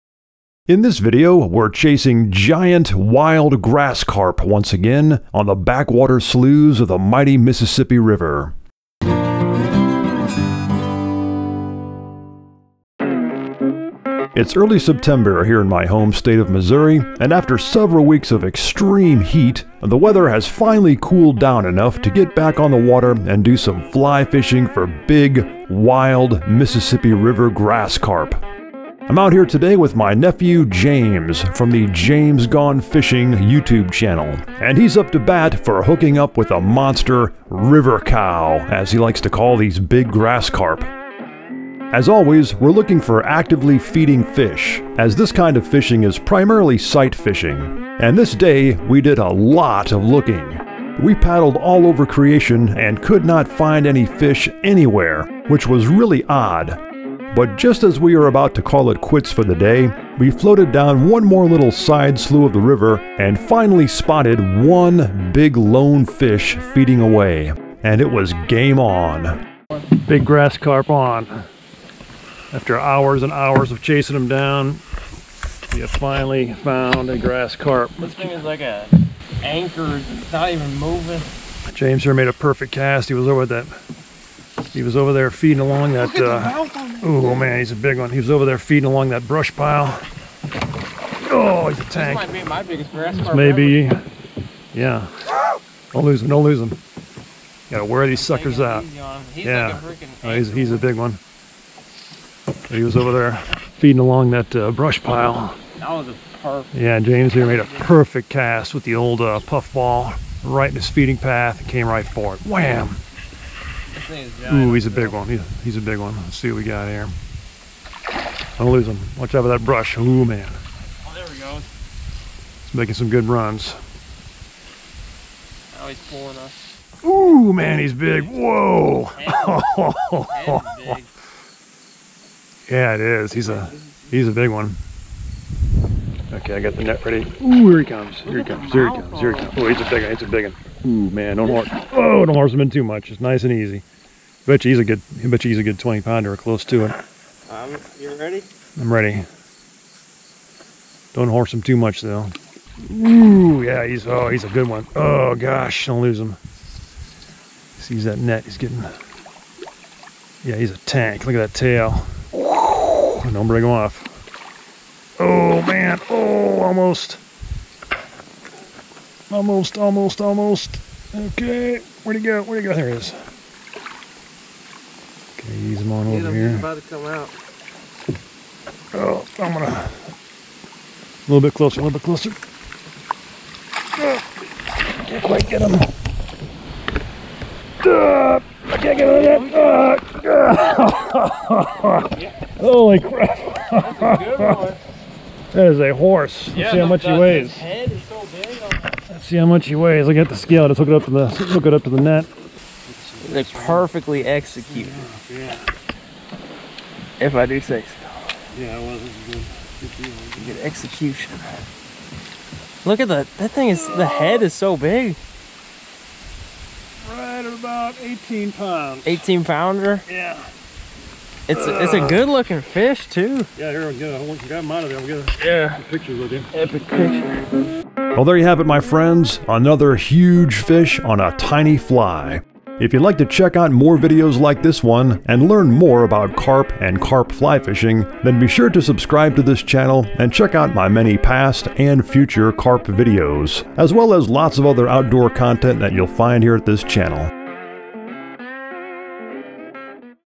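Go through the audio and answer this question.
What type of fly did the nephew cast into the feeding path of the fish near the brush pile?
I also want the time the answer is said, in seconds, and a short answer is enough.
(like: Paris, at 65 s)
Puff ball, at 109 s.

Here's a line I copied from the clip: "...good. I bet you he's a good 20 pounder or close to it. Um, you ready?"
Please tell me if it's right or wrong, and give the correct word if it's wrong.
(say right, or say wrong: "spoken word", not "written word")
right.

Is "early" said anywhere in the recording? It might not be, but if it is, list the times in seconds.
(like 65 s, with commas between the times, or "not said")
14 s.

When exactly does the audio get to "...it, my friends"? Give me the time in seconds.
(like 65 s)
228 s.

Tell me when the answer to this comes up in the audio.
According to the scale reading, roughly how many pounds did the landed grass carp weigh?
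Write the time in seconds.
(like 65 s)
217 s.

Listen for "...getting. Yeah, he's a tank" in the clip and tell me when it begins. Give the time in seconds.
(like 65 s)
158 s.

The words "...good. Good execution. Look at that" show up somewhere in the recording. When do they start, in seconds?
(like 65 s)
209 s.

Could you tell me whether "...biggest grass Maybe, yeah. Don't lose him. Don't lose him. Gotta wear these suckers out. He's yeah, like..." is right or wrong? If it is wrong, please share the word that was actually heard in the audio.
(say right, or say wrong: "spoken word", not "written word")
right.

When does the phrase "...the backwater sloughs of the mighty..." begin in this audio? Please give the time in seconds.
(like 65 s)
5 s.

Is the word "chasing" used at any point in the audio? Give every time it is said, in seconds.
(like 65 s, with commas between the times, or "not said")
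1 s, 73 s.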